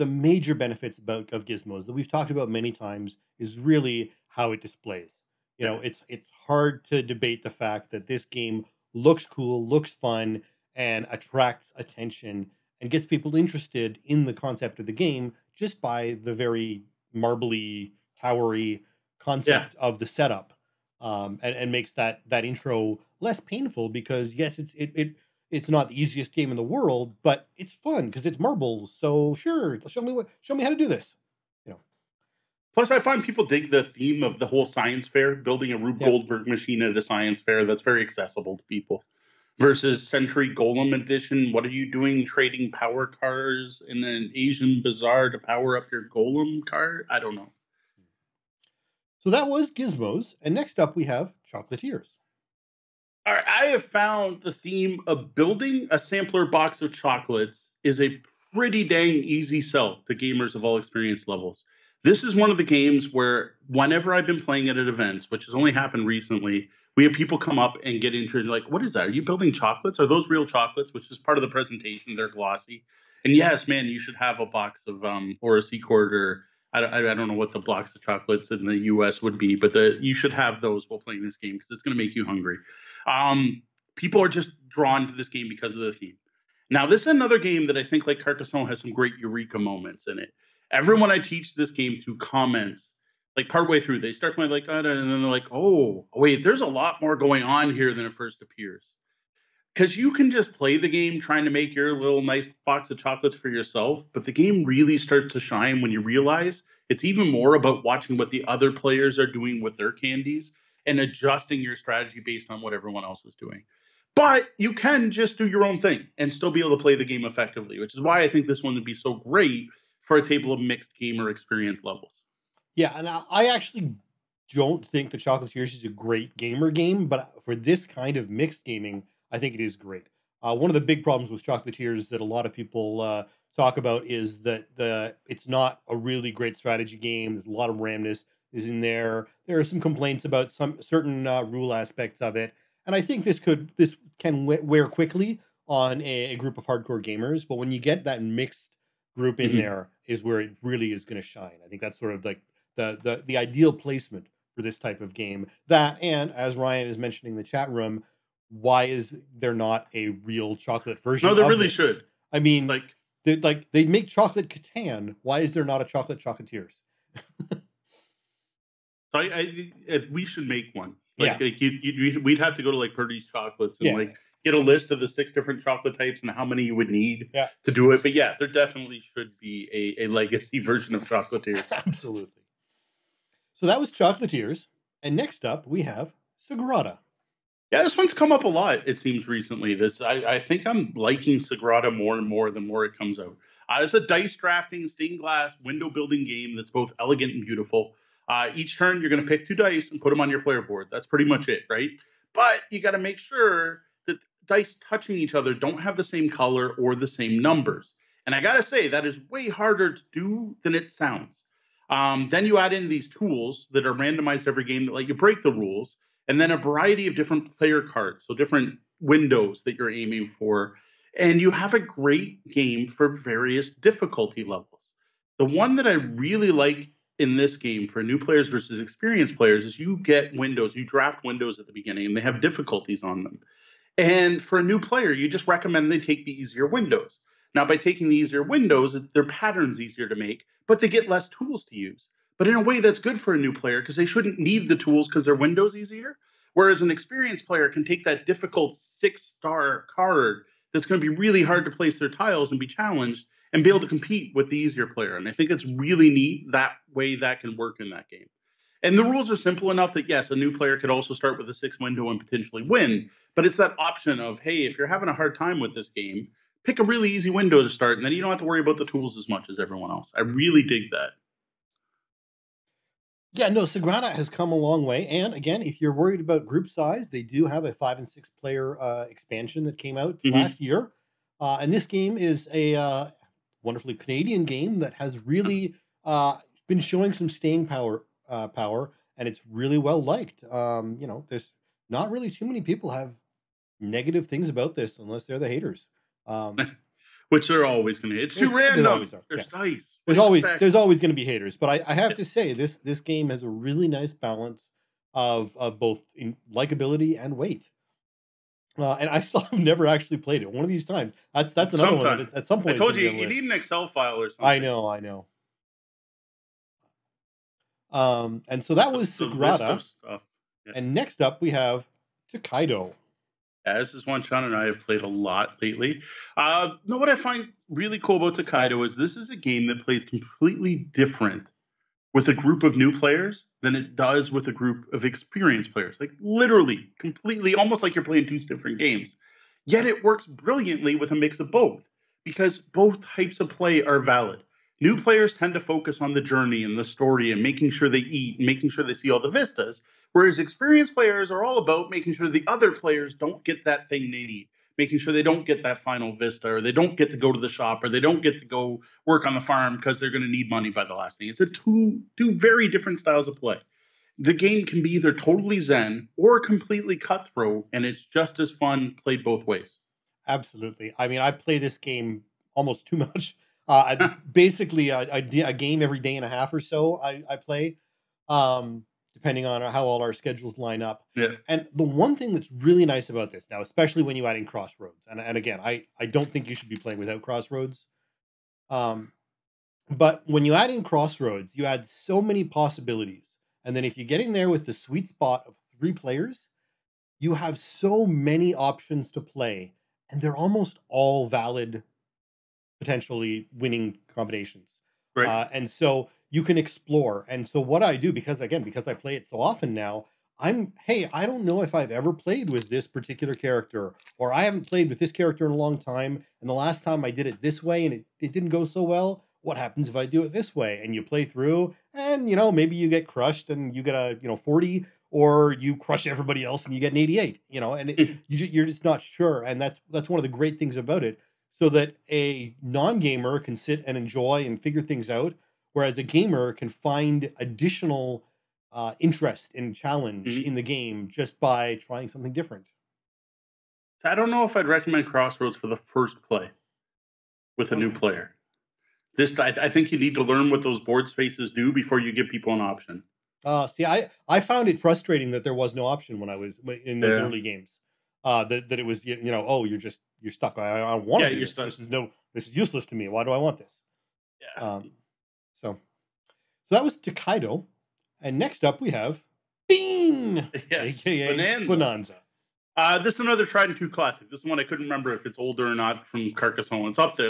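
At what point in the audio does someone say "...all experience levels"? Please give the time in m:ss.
1:00.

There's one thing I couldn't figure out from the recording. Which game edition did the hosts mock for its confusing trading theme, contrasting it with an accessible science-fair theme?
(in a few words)
Century Golem Edition.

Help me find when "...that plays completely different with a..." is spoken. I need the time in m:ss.
5:29.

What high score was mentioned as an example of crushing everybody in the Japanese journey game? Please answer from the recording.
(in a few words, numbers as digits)
88.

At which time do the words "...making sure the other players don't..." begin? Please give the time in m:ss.
5:51.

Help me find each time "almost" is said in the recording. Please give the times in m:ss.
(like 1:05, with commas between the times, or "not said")
5:37, 6:12, 6:40.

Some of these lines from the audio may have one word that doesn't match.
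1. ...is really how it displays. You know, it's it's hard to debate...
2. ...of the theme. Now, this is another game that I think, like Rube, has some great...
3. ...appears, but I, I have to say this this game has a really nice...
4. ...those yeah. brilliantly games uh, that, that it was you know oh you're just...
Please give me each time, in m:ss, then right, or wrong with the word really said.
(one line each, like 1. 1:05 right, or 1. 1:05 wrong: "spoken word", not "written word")
1. 0:03 right
2. 1:25 wrong: "Carcassonne", not "Rube"
3. 5:01 wrong: "haters", not "appears"
4. 7:36 wrong: "early", not "brilliantly".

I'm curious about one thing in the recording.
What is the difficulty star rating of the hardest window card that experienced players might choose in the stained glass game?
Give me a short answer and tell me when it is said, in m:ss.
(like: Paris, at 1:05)
6, at 4:08.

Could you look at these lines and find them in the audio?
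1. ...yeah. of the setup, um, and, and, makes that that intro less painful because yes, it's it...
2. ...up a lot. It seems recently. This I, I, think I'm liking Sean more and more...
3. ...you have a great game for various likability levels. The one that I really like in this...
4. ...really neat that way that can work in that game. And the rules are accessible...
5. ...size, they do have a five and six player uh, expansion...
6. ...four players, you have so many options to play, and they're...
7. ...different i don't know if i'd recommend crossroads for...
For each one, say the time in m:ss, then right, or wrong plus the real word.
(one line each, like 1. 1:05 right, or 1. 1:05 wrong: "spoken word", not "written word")
1. 0:19 right
2. 3:08 wrong: "Sagrada", not "Sean"
3. 3:41 wrong: "difficulty", not "likability"
4. 4:15 wrong: "simple", not "accessible"
5. 4:36 right
6. 6:35 wrong: "three", not "four"
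7. 7:22 right.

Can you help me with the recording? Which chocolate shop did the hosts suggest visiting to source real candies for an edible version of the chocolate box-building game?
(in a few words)
Purdy's Chocolates.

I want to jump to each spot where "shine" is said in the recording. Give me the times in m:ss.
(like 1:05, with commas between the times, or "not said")
1:45, 2:31.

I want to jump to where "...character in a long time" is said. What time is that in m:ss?
6:55.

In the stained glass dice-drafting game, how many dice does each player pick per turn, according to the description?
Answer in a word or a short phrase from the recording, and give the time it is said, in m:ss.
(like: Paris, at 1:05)
2, at 3:19.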